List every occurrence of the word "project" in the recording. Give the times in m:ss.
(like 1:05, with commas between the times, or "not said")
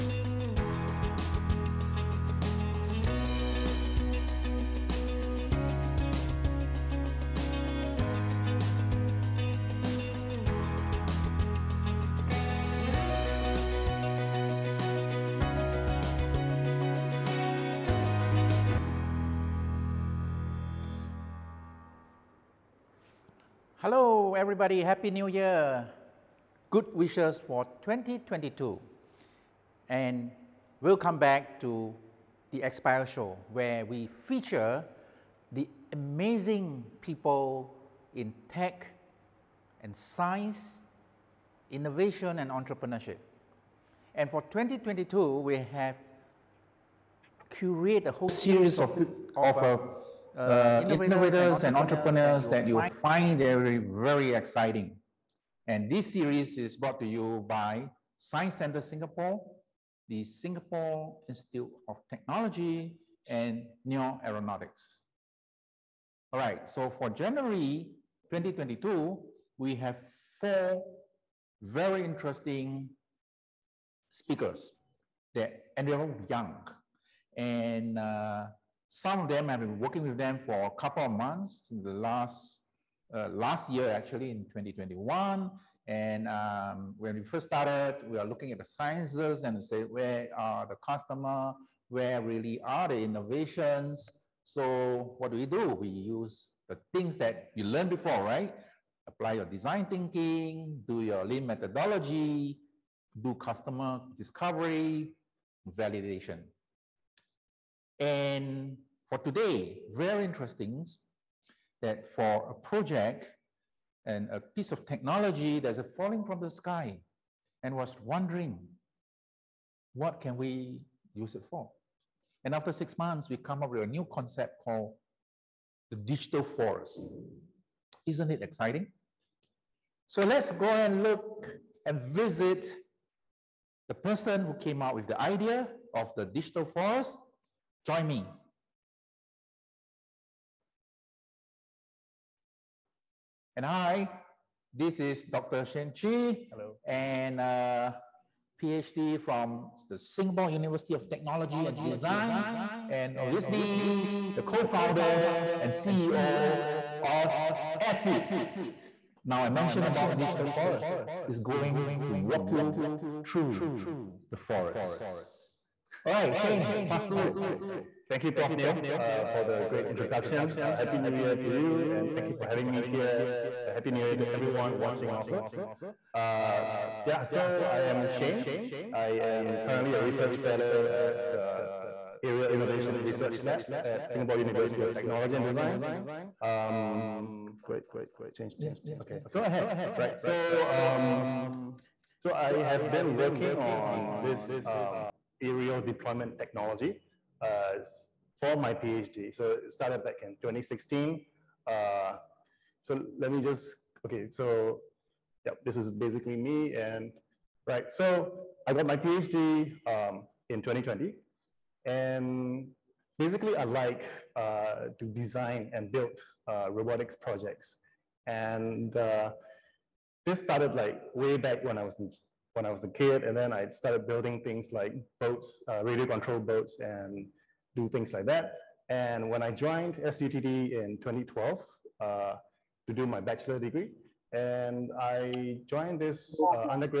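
1:52, 3:37.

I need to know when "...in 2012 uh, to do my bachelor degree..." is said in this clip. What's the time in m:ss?
3:50.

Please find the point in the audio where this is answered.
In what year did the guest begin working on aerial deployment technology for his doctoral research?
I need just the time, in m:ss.
3:20.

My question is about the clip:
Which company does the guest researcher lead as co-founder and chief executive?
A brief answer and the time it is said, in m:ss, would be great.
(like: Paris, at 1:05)
AirXeed, at 2:37.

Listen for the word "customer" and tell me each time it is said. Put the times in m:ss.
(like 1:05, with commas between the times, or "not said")
1:30, 1:43.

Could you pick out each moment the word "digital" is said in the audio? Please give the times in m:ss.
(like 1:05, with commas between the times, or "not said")
2:05, 2:16, 2:40.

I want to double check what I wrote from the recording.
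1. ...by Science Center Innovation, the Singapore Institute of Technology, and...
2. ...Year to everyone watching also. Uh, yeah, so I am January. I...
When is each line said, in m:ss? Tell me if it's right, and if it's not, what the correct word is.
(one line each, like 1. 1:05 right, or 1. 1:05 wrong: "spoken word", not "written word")
1. 0:57 wrong: "Singapore", not "Innovation"
2. 2:54 wrong: "Shane", not "January".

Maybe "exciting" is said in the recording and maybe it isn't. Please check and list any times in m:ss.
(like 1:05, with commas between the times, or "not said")
0:54, 2:08.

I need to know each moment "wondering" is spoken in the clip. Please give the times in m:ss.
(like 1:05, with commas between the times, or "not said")
1:58.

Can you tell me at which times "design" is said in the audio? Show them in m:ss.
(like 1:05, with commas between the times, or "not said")
1:39, 2:31, 3:05, 3:35.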